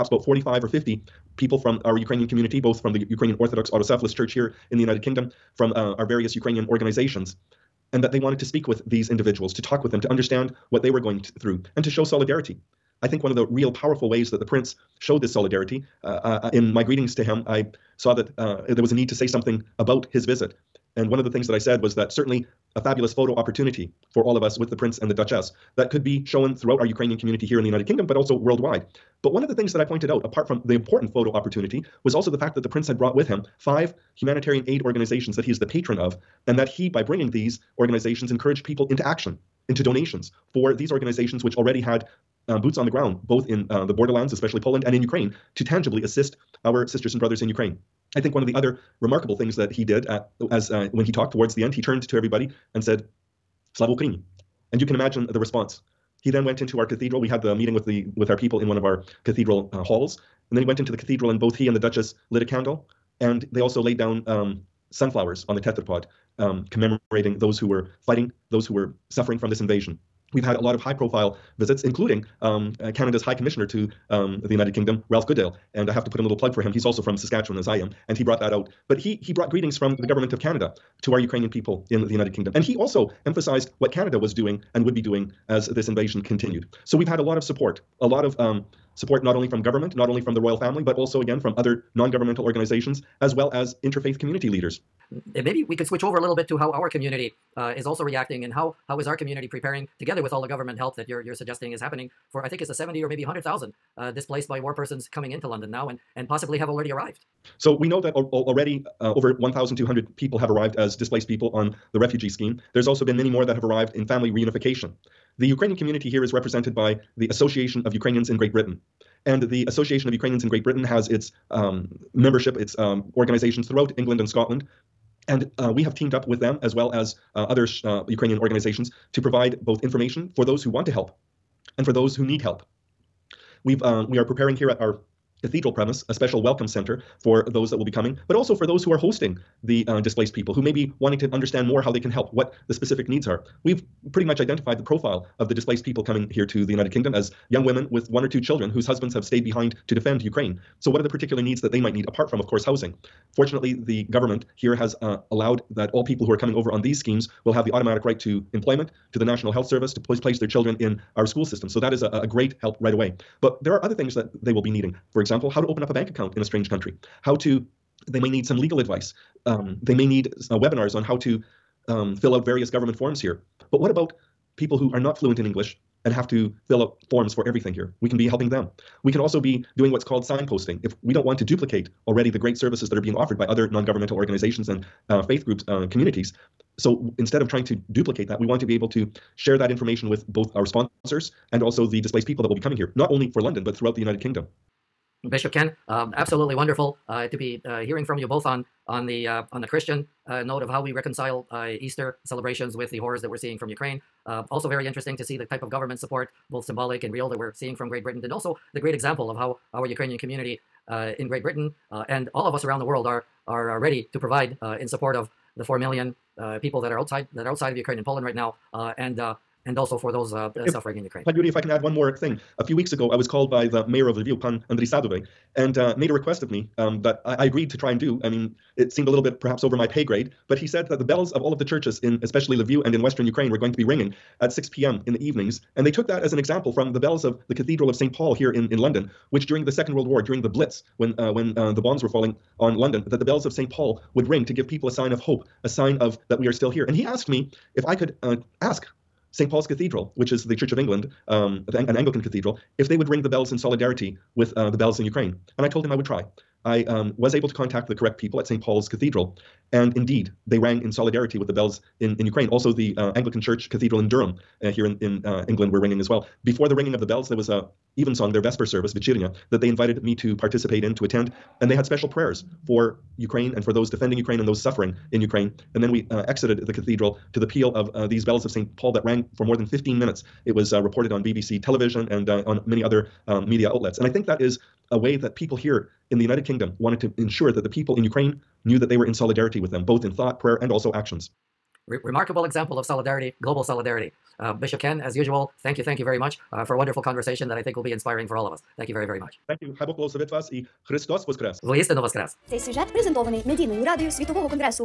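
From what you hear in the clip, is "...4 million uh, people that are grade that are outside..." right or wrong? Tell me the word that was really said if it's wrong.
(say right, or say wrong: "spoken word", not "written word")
wrong: "outside", not "grade".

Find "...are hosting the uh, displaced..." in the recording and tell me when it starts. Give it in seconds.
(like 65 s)
138 s.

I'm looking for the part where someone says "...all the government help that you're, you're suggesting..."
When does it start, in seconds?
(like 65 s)
100 s.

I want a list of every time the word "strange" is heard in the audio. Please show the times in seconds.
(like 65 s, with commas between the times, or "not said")
166 s.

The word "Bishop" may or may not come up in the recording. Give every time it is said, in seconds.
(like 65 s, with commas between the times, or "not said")
195 s, 294 s.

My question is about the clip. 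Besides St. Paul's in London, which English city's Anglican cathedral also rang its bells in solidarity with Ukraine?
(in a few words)
Durham.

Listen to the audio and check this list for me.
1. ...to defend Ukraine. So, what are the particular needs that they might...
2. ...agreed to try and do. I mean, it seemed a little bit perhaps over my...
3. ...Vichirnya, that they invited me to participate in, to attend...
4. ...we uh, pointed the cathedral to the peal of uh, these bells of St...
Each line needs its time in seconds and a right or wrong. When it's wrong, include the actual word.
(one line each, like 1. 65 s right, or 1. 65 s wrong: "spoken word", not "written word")
1. 149 s right
2. 227 s right
3. 268 s right
4. 275 s wrong: "exited", not "pointed".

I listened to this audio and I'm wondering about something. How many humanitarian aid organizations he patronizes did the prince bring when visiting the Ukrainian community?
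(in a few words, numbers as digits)
5.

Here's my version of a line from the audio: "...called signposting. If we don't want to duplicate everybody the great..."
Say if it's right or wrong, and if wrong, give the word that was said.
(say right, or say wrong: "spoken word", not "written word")
wrong: "already", not "everybody".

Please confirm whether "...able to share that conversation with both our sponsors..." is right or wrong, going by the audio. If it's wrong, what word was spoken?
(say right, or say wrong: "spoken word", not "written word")
wrong: "information", not "conversation".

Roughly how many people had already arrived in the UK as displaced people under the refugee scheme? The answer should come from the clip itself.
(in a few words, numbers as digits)
over 1,200.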